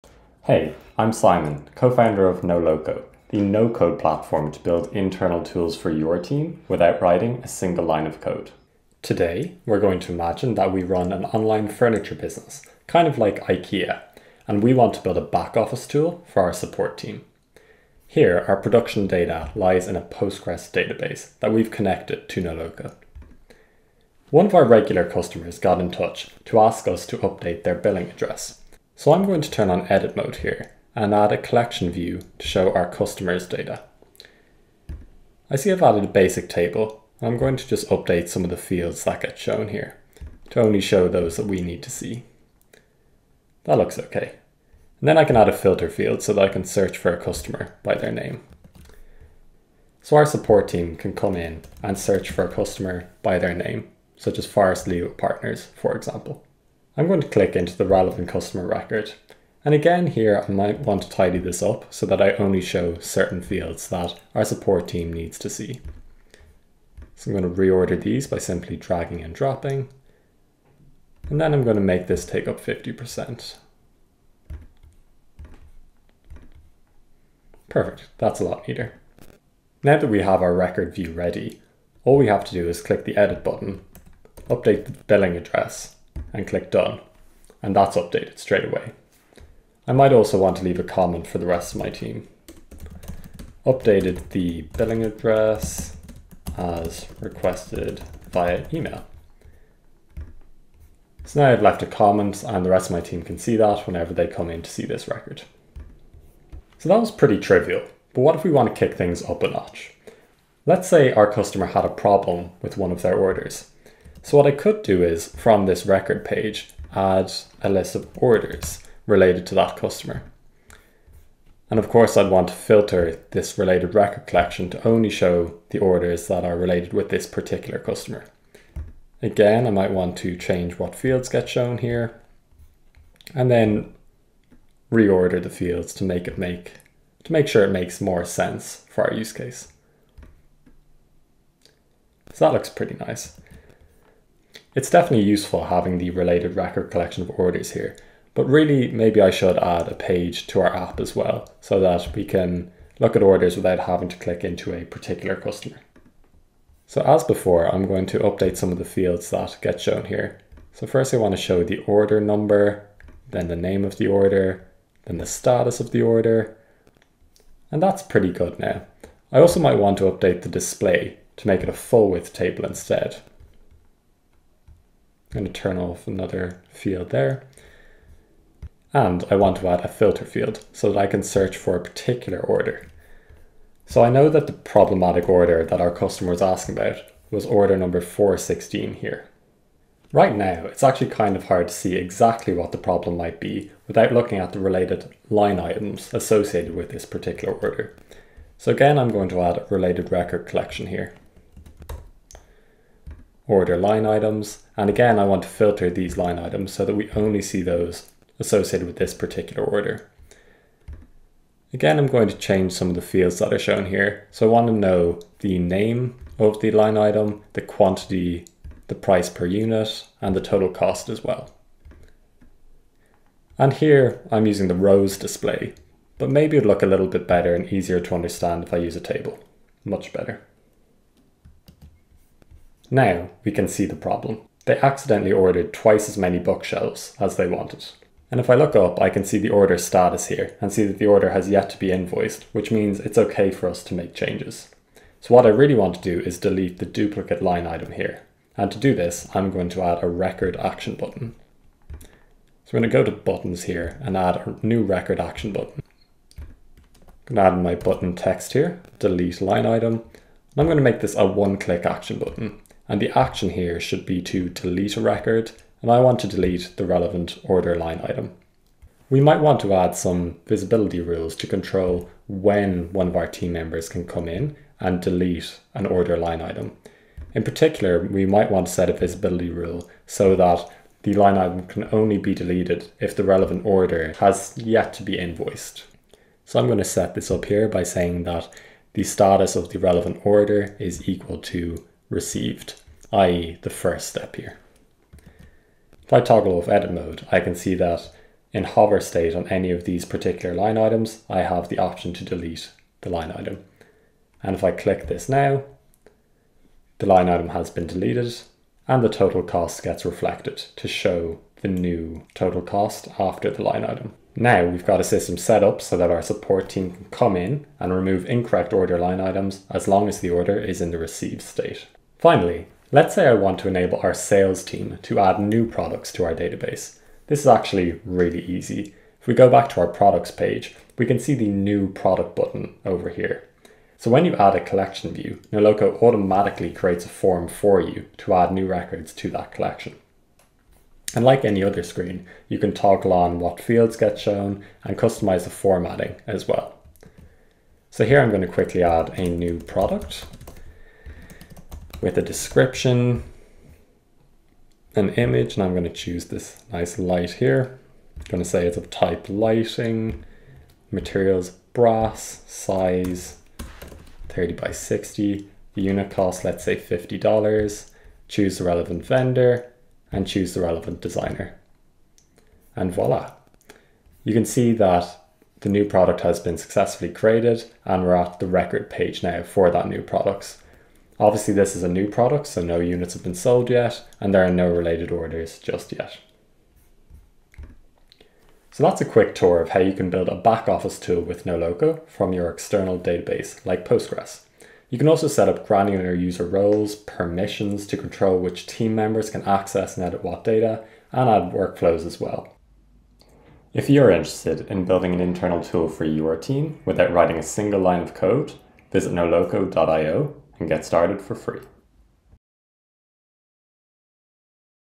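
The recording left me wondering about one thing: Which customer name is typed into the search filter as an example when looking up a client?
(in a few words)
Forest Leo Partners.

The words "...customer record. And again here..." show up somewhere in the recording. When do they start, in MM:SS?
00:58.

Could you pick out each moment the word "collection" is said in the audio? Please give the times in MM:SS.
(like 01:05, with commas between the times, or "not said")
00:31, 02:04, 02:26, 03:20, 05:34, 05:39.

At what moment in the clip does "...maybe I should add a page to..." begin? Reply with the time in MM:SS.
02:28.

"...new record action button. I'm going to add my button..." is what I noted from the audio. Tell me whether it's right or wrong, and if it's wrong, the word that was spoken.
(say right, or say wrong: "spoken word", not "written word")
right.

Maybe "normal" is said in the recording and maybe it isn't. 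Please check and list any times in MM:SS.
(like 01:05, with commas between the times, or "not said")
not said.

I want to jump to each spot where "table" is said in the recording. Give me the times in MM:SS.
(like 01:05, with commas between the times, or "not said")
00:36, 02:52, 03:49.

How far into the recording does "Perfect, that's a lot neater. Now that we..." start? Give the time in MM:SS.
01:17.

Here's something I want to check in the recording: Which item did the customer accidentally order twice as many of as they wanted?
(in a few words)
Bookshelves.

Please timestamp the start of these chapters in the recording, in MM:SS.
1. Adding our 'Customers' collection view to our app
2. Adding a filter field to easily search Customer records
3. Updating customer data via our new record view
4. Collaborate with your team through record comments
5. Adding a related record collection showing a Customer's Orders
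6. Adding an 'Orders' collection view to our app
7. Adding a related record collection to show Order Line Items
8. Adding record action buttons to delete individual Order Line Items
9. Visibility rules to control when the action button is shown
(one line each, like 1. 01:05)
1. 00:24
2. 00:44
3. 01:19
4. 01:29
5. 01:54
6. 02:29
7. 03:17
8. 04:09
9. 04:30.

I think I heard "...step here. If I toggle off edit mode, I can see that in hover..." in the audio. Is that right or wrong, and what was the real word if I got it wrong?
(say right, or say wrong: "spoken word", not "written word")
right.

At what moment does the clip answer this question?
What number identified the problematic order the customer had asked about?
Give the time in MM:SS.
03:08.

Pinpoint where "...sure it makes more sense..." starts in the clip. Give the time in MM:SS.
02:17.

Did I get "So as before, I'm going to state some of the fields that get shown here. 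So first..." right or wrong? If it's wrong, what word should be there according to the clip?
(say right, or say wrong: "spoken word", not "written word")
wrong: "update", not "state".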